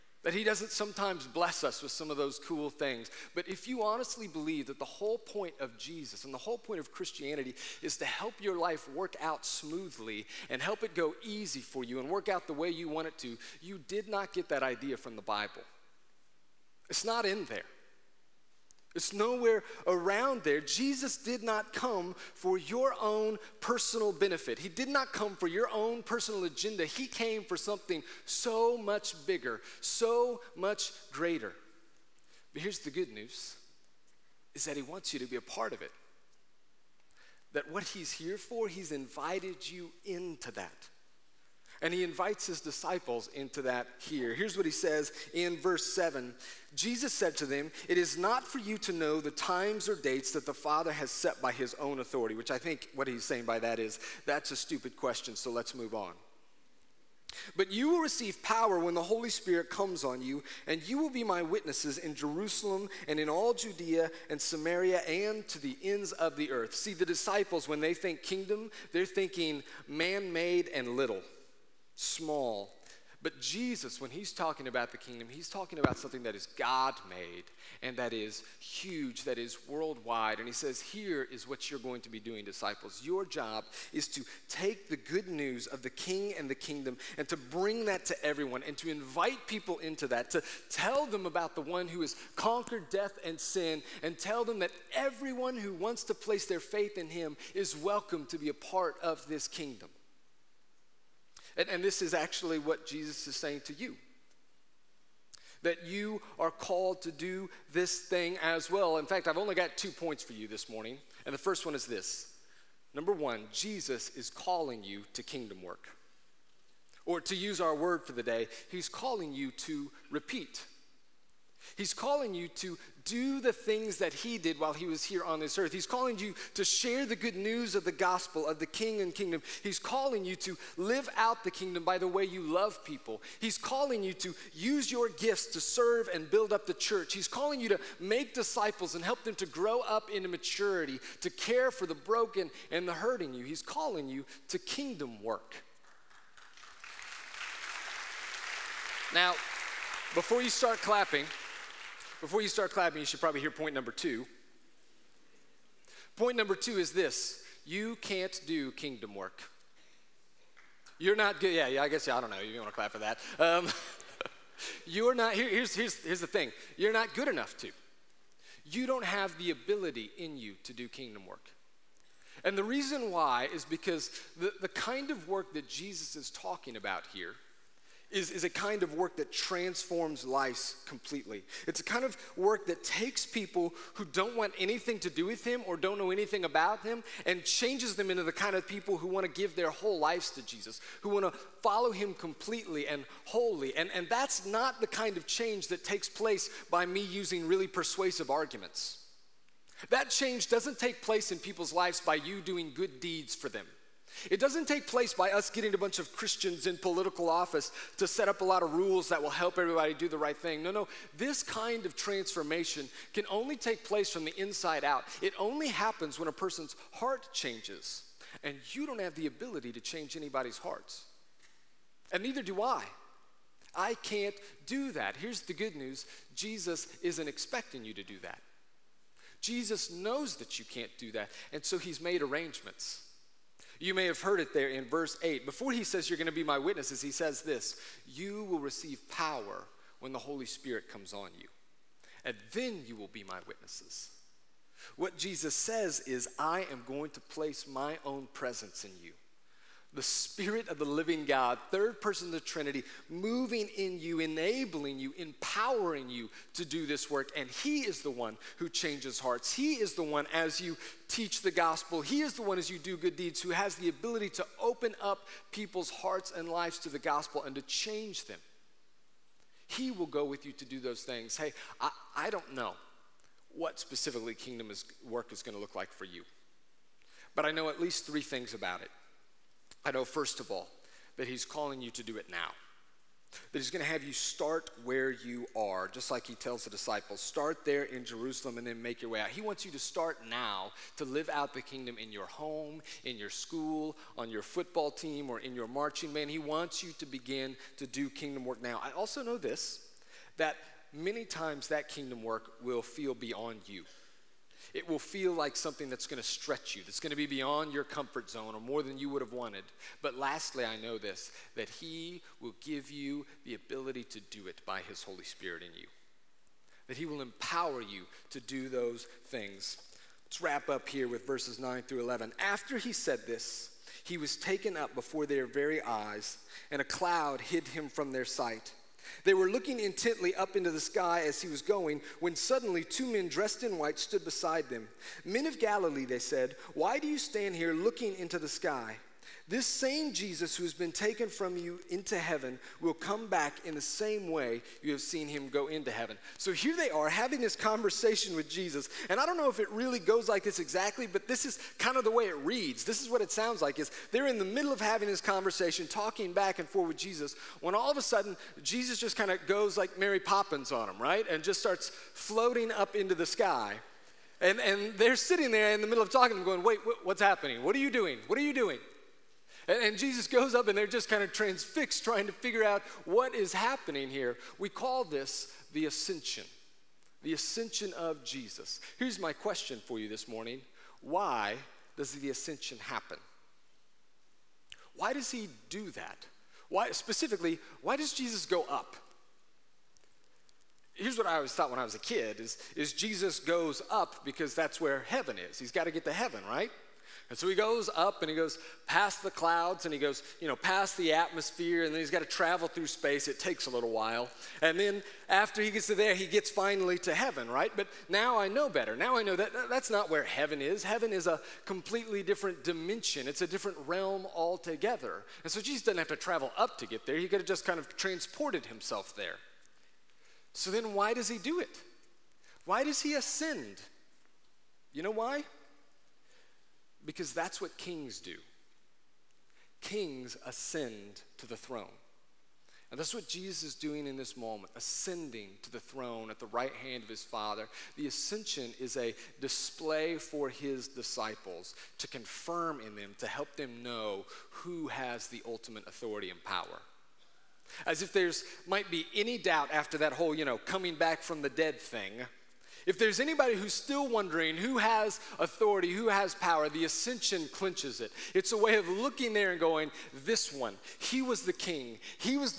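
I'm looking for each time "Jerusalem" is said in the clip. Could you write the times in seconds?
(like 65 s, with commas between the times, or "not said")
62 s, 288 s.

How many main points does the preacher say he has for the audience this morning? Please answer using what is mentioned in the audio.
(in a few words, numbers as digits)
2.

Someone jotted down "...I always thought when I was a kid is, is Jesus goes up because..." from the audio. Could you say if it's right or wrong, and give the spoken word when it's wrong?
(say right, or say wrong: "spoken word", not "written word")
right.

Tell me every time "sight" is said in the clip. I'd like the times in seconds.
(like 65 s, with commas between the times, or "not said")
328 s.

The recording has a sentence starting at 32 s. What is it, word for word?
But here's the good news is that he wants you to be a part of it.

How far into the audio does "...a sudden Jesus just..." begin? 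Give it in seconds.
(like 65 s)
357 s.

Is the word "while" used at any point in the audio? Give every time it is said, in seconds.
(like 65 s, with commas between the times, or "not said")
124 s, 403 s.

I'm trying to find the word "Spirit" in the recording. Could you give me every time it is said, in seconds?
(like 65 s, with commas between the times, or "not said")
59 s, 240 s, 250 s, 315 s.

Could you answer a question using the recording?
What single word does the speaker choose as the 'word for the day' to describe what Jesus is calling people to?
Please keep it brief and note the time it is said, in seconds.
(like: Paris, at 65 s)
repeat, at 120 s.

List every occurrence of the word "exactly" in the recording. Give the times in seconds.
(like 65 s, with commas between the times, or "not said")
350 s.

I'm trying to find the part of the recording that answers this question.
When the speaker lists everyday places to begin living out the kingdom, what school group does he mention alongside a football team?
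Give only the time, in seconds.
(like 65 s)
295 s.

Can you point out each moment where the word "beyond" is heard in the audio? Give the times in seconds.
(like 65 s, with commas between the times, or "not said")
303 s, 307 s.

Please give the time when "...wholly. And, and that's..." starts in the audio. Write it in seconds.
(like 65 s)
193 s.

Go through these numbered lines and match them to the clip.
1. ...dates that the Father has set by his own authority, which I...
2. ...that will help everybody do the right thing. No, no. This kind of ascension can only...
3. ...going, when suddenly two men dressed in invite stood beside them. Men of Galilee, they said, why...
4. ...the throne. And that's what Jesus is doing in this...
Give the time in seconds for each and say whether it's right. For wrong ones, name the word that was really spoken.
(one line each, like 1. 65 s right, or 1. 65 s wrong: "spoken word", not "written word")
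1. 49 s right
2. 209 s wrong: "transformation", not "ascension"
3. 331 s wrong: "white", not "invite"
4. 431 s right.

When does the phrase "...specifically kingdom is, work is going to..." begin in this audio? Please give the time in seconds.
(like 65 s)
273 s.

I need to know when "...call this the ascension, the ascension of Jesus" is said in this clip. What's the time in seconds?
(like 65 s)
374 s.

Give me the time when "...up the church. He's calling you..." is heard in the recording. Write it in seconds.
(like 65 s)
136 s.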